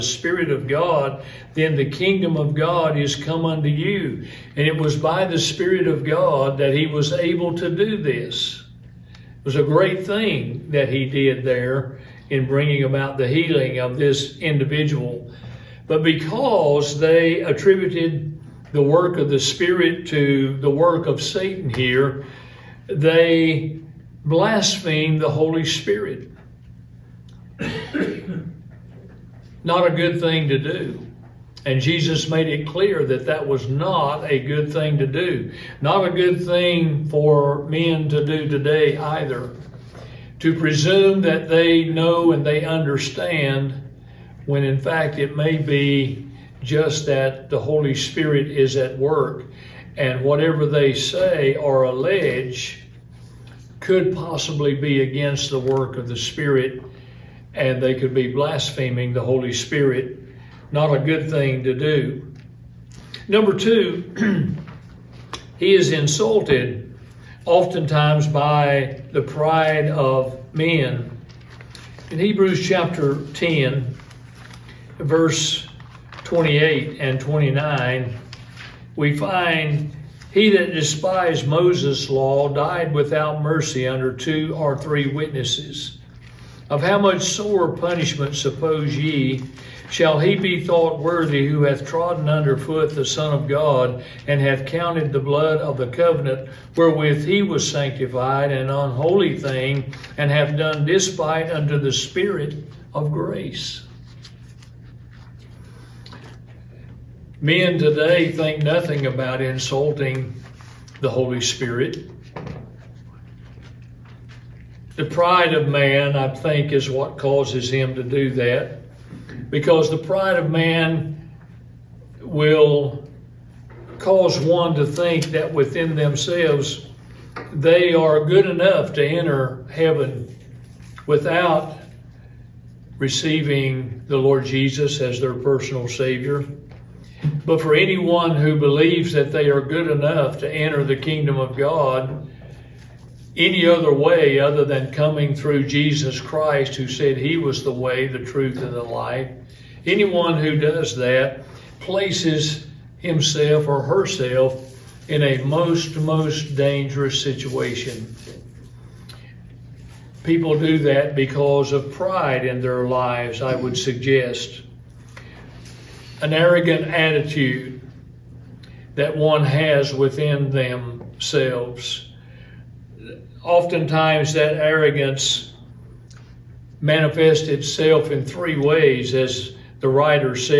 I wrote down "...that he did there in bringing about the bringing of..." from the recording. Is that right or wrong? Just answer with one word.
wrong.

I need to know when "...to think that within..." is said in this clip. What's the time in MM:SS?
02:04.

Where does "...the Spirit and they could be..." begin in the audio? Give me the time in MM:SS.
00:56.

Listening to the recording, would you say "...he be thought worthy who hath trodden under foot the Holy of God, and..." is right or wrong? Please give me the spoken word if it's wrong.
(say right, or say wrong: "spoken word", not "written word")
wrong: "Son", not "Holy".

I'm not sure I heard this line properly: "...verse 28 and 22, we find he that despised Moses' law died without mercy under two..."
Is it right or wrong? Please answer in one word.
wrong.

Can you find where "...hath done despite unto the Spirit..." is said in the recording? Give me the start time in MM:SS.
01:40.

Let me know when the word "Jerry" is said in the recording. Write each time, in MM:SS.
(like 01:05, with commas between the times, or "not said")
not said.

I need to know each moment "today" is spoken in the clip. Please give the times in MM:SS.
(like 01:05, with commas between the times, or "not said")
00:38, 01:47.